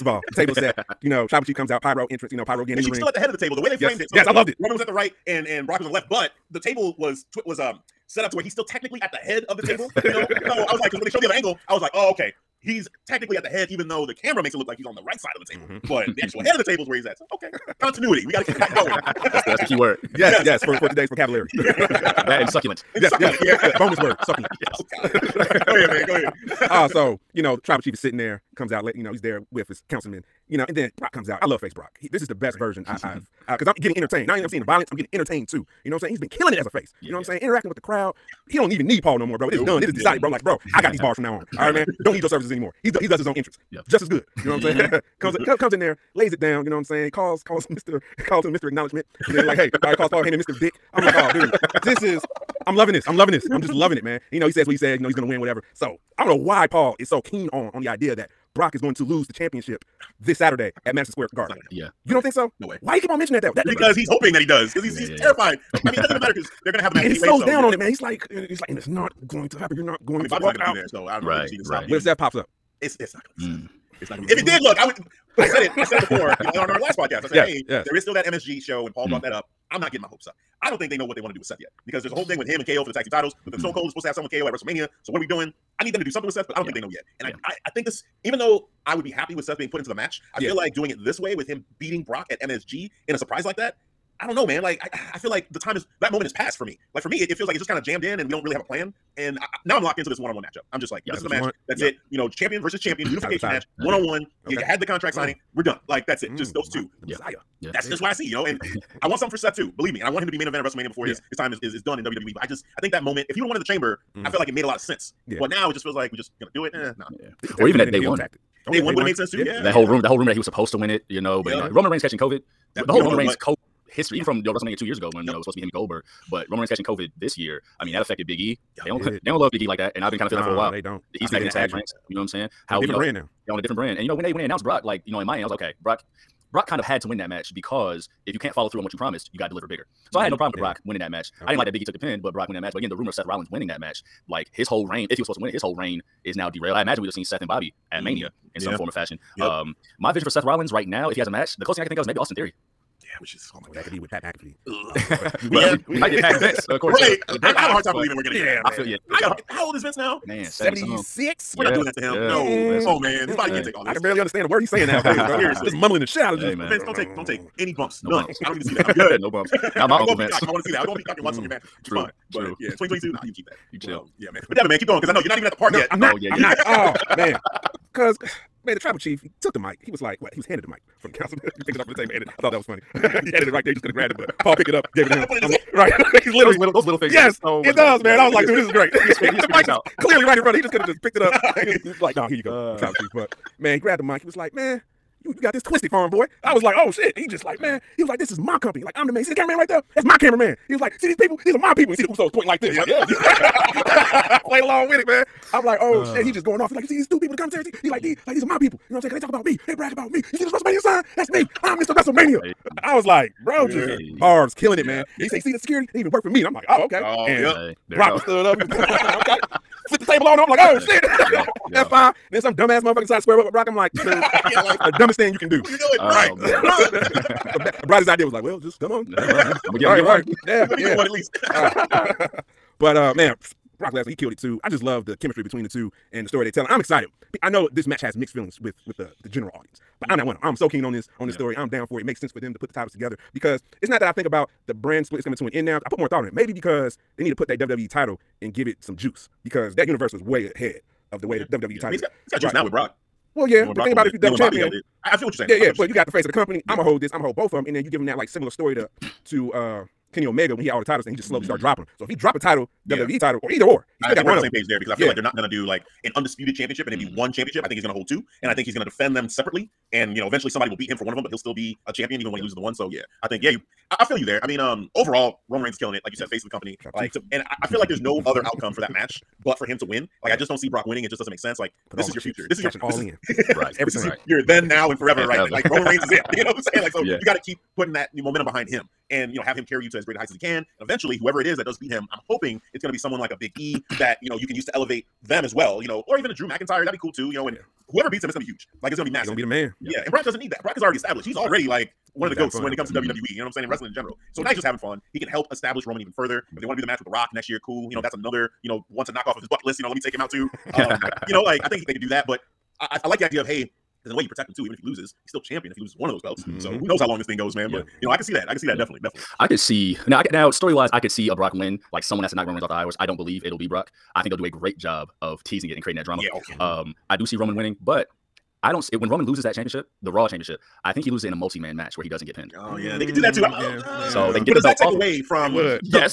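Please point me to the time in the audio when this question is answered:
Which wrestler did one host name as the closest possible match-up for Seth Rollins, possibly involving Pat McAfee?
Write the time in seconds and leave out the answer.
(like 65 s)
152 s.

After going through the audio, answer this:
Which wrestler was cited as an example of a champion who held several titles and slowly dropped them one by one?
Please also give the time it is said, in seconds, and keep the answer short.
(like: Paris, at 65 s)
Kenny Omega, at 260 s.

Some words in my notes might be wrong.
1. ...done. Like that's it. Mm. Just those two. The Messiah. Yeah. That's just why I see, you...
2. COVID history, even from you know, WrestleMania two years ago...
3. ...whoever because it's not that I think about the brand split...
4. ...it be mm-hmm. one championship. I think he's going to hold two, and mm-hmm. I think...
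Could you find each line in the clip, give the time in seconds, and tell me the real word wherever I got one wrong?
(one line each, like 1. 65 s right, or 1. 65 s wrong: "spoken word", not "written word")
1. 105 s right
2. 123 s right
3. 242 s wrong: "together", not "whoever"
4. 266 s right.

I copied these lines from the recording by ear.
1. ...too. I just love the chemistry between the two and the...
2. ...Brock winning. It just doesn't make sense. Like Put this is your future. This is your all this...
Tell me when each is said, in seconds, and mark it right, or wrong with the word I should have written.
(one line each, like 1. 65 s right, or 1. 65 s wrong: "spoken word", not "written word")
1. 234 s right
2. 280 s right.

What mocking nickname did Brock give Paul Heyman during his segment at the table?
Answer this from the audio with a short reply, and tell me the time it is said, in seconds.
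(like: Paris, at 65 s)
Mr. Dick, at 50 s.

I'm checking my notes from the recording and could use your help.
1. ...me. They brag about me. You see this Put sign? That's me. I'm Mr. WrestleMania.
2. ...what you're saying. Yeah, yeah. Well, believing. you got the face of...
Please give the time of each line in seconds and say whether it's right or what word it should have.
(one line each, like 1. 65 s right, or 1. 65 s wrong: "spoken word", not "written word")
1. 209 s wrong: "WrestleMania", not "Put"
2. 255 s wrong: "saying", not "believing".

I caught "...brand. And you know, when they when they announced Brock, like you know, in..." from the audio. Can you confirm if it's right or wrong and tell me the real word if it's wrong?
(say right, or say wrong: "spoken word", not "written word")
right.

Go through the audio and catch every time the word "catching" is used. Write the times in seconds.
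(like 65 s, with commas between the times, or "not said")
122 s, 126 s.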